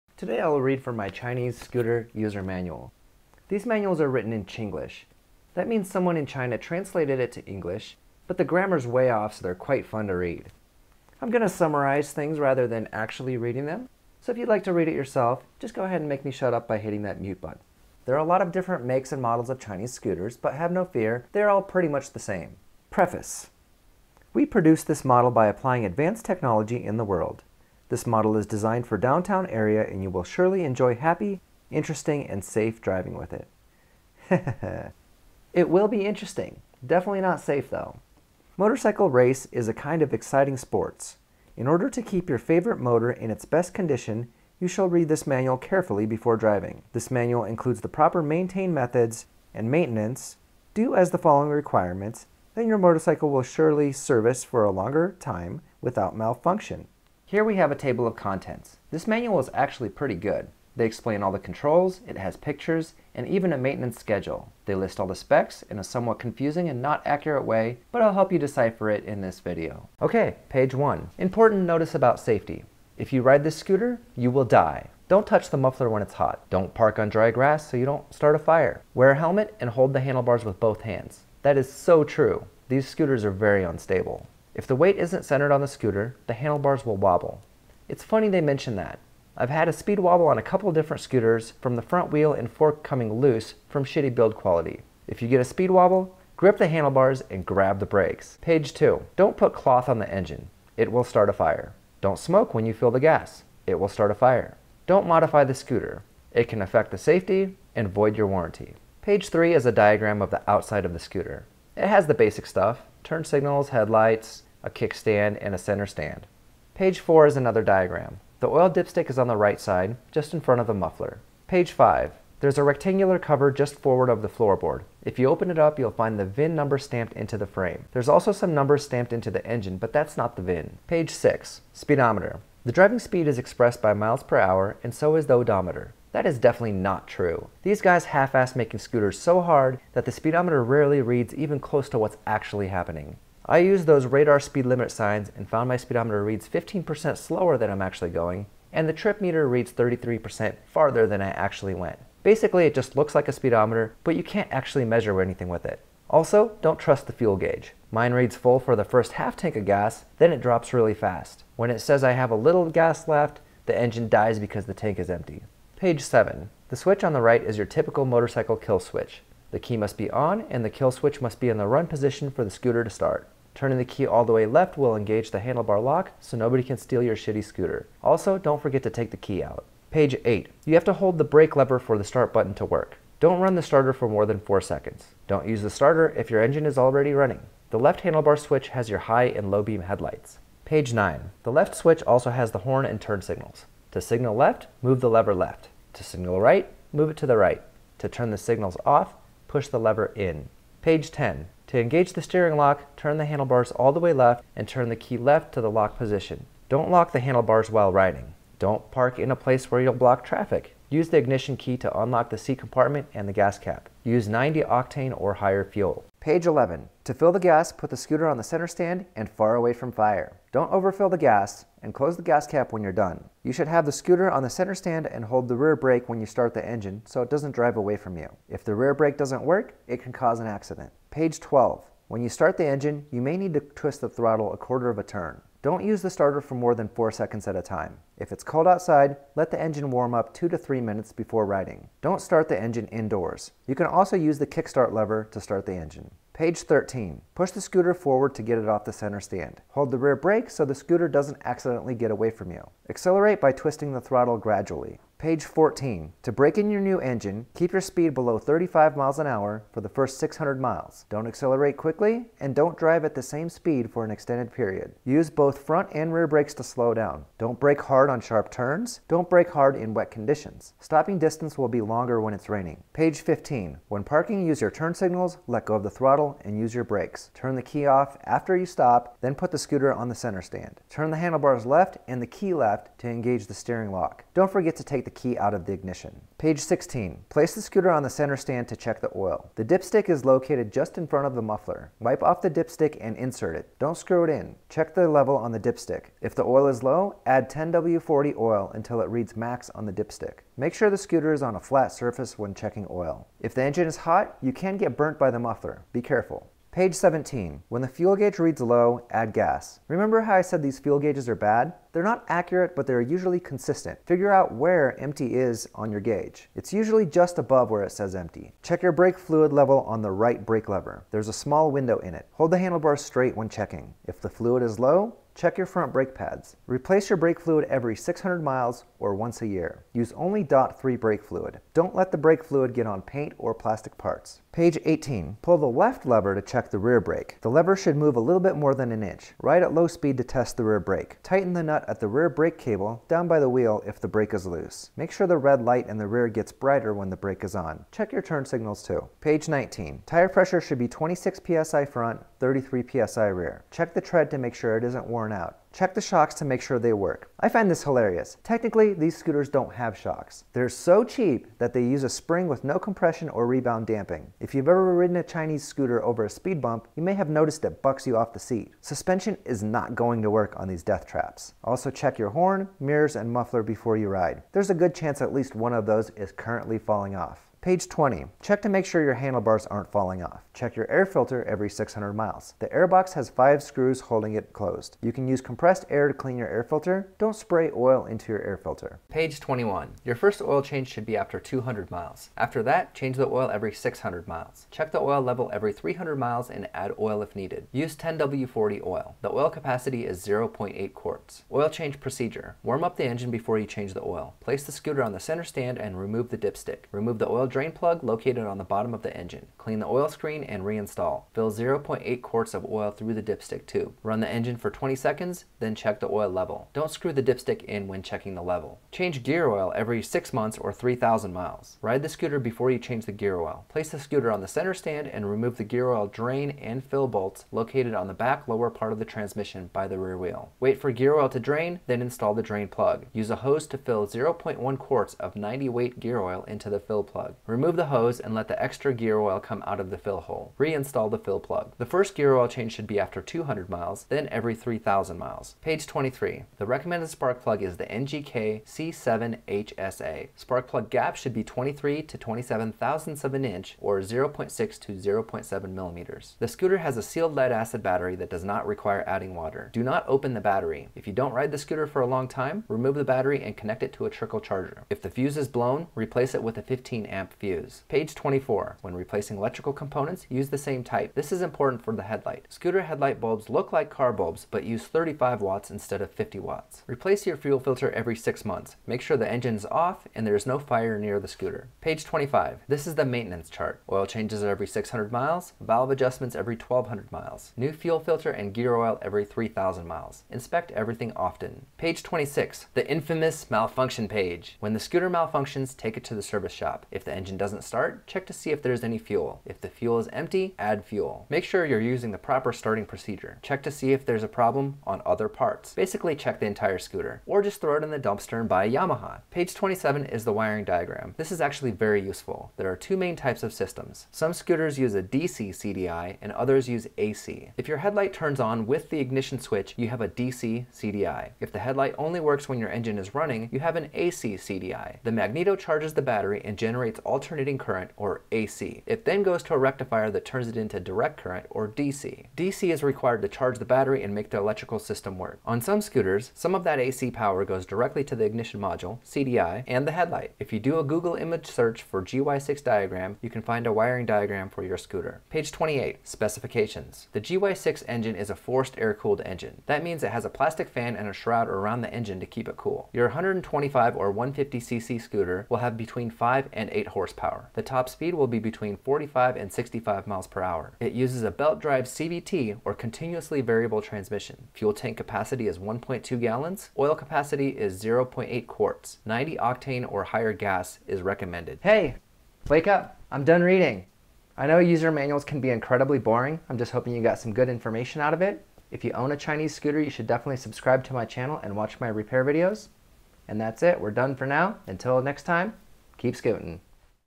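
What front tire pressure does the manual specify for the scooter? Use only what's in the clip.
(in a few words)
26 psi.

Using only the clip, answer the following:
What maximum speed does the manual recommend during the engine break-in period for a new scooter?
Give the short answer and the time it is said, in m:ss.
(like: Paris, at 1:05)
35 mph, at 4:18.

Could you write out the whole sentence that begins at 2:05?
If you open it up, you'll find the VIN number stamped into the frame.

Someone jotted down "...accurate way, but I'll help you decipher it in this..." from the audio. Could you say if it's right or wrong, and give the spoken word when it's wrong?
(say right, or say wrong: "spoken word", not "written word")
right.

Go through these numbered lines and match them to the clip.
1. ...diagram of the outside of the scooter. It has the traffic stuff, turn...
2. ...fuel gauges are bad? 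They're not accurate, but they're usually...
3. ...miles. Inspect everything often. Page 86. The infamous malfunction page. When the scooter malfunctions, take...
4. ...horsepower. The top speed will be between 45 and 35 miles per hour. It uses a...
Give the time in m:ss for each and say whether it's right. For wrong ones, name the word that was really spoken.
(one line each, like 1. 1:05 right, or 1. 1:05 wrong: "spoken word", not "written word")
1. 1:49 wrong: "basic", not "traffic"
2. 5:10 right
3. 8:09 wrong: "26", not "86"
4. 9:16 wrong: "65", not "35".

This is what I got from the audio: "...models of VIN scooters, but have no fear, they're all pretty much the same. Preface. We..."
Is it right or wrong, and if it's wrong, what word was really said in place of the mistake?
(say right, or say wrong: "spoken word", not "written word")
wrong: "Chinese", not "VIN".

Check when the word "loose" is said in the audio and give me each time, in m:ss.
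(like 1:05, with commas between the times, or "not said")
1:33, 5:44.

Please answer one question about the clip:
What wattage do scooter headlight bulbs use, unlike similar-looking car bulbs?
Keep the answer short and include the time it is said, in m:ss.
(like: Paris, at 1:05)
35 watts, at 7:54.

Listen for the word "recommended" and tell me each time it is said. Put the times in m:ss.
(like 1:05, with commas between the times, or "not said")
7:26, 9:31.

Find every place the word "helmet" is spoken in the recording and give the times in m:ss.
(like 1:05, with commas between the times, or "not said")
1:19.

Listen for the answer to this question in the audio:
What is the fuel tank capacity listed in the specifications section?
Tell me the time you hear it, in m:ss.
9:25.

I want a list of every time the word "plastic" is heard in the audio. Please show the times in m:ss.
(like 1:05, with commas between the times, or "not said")
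5:33, 9:10.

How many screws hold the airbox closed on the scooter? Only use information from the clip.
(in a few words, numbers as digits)
five.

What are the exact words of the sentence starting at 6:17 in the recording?
Page 20, check to make sure your handlebars aren't falling off.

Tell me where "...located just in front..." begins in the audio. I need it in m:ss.
4:50.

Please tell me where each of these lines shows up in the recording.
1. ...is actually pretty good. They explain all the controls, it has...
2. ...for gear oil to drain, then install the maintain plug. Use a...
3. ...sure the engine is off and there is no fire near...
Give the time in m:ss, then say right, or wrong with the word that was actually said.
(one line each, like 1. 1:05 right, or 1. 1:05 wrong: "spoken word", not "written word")
1. 0:59 right
2. 7:10 wrong: "drain", not "maintain"
3. 7:59 right.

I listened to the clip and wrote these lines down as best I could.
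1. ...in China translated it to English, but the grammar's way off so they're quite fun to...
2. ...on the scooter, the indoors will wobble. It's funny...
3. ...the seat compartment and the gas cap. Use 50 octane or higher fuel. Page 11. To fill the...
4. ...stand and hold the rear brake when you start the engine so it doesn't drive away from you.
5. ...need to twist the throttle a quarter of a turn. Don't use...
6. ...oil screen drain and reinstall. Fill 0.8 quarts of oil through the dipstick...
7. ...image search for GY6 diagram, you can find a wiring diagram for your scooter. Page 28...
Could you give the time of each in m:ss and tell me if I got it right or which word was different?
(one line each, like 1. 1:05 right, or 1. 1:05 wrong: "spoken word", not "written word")
1. 0:06 right
2. 1:25 wrong: "handlebars", not "indoors"
3. 3:32 wrong: "90", not "50"
4. 3:44 right
5. 3:53 right
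6. 6:49 right
7. 9:01 right.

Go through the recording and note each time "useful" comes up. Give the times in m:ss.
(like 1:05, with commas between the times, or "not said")
8:32.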